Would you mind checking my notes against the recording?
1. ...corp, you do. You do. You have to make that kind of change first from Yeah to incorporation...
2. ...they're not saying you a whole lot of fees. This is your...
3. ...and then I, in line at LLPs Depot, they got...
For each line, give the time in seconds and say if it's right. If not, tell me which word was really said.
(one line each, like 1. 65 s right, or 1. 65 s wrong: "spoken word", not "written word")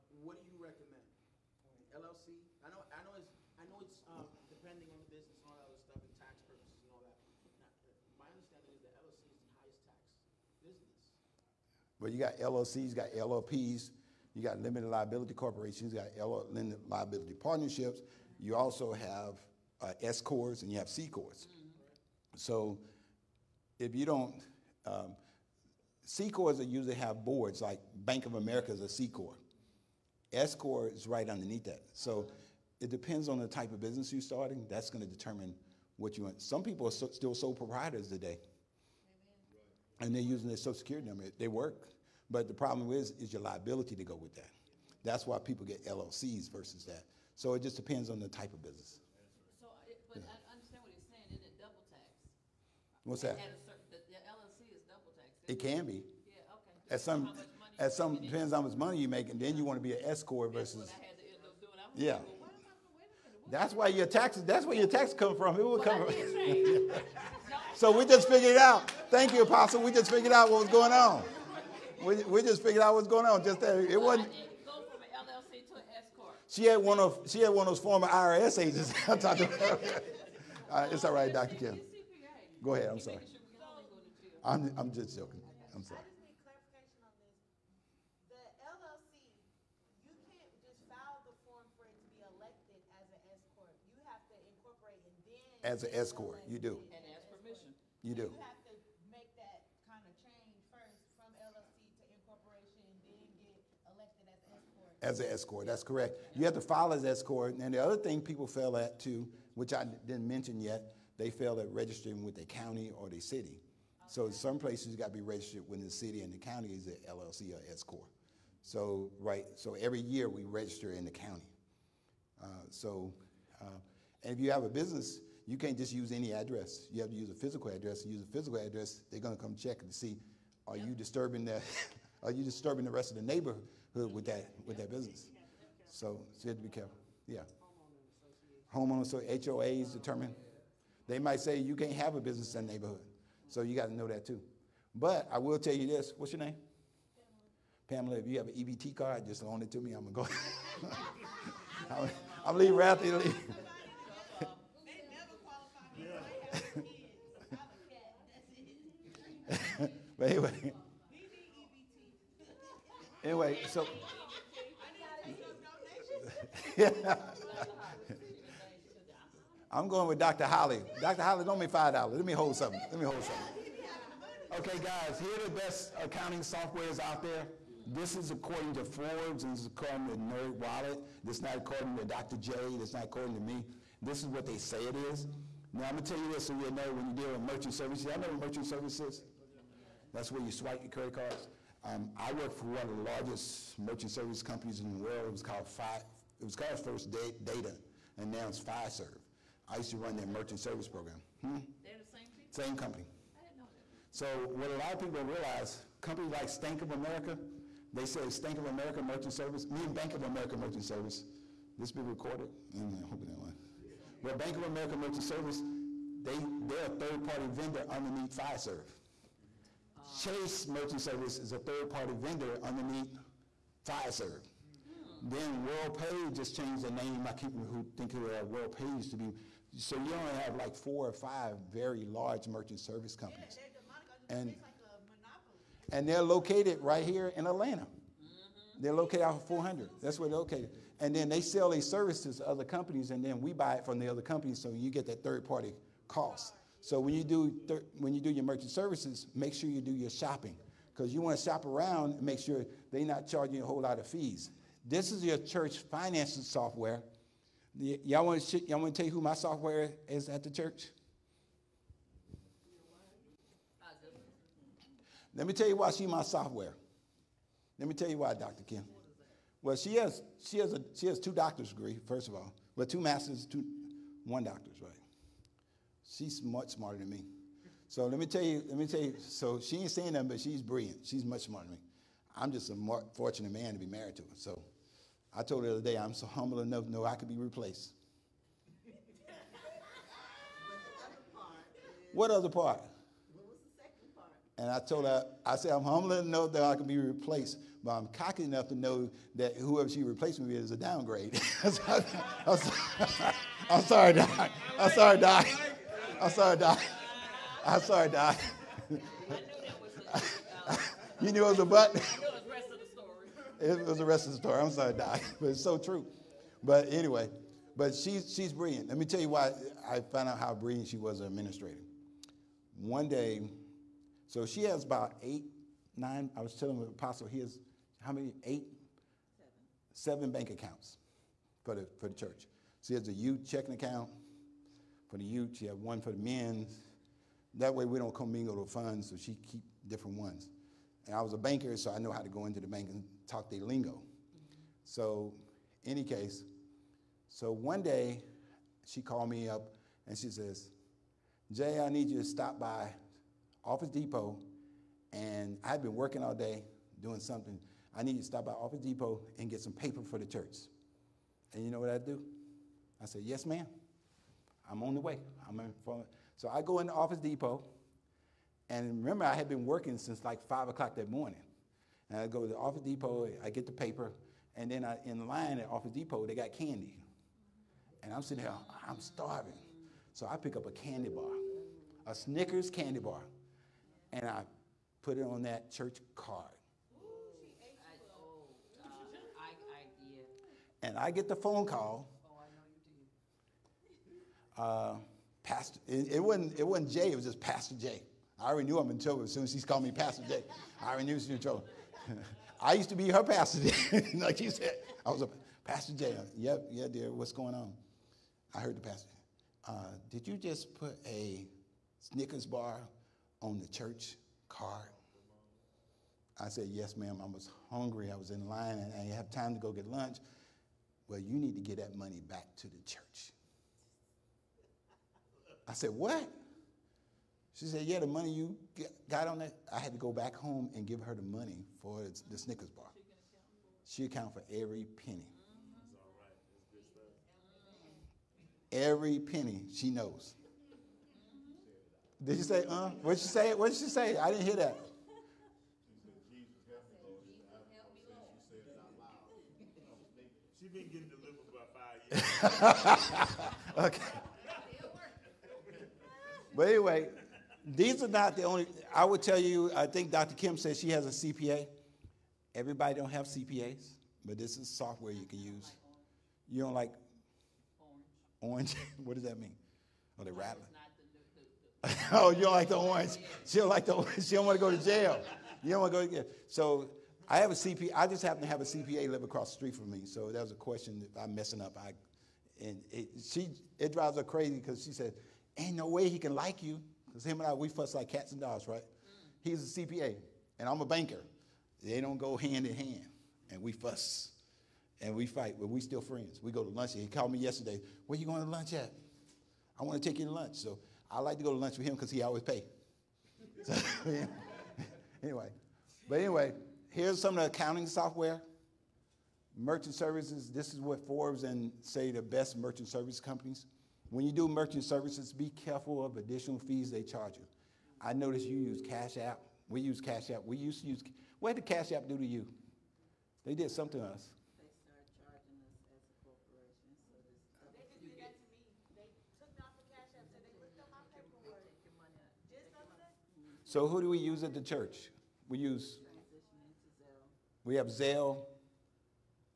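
1. 96 s wrong: "LLC", not "Yeah"
2. 252 s wrong: "charging", not "saying"
3. 374 s wrong: "Office", not "LLPs".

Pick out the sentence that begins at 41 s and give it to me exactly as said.
They work, but the problem is is your liability to go with that.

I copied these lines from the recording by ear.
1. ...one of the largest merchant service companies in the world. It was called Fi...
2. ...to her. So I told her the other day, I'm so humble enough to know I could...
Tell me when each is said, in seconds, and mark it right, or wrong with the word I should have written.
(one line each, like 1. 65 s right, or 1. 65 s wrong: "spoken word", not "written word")
1. 192 s right
2. 284 s right.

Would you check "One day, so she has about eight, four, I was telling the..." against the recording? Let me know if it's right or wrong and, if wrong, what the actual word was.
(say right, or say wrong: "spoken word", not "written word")
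wrong: "nine", not "four".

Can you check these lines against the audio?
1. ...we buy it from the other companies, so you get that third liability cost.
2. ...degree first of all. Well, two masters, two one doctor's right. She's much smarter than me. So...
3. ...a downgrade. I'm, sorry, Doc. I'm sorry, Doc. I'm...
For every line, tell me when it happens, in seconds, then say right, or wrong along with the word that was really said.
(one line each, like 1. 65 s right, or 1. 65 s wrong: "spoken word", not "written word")
1. 243 s wrong: "party", not "liability"
2. 271 s right
3. 300 s right.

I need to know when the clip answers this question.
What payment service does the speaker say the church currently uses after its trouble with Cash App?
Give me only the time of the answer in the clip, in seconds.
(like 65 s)
537 s.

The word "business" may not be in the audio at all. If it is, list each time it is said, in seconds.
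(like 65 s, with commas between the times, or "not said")
33 s, 48 s, 124 s, 134 s, 142 s.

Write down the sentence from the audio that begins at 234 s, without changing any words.
Yeah, and, like and they're located right here in Atlanta.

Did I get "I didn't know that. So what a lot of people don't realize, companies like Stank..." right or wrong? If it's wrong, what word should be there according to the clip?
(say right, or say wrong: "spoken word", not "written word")
right.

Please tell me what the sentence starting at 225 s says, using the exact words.
Then WorldPay just changed the name.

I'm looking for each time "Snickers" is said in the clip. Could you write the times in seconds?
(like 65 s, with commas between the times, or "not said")
382 s, 411 s, 432 s.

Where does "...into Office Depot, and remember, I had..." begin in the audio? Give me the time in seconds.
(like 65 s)
366 s.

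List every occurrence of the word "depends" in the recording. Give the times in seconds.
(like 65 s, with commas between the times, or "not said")
32 s, 47 s, 58 s.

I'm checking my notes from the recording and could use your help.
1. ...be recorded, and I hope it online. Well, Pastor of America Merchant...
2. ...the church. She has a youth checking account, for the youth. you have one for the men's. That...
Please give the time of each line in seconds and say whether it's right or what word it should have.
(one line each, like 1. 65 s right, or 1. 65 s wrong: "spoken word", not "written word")
1. 211 s wrong: "Bank", not "Pastor"
2. 332 s right.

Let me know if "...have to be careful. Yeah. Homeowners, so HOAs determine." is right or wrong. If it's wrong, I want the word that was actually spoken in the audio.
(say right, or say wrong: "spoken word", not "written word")
right.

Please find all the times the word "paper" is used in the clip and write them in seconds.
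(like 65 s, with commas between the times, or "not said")
359 s, 373 s.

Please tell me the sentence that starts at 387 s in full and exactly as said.
Oh, um, and I get the phone call uh, pastor, it, it, wasn't, it wasn't Jay, it was just Pastor Jay.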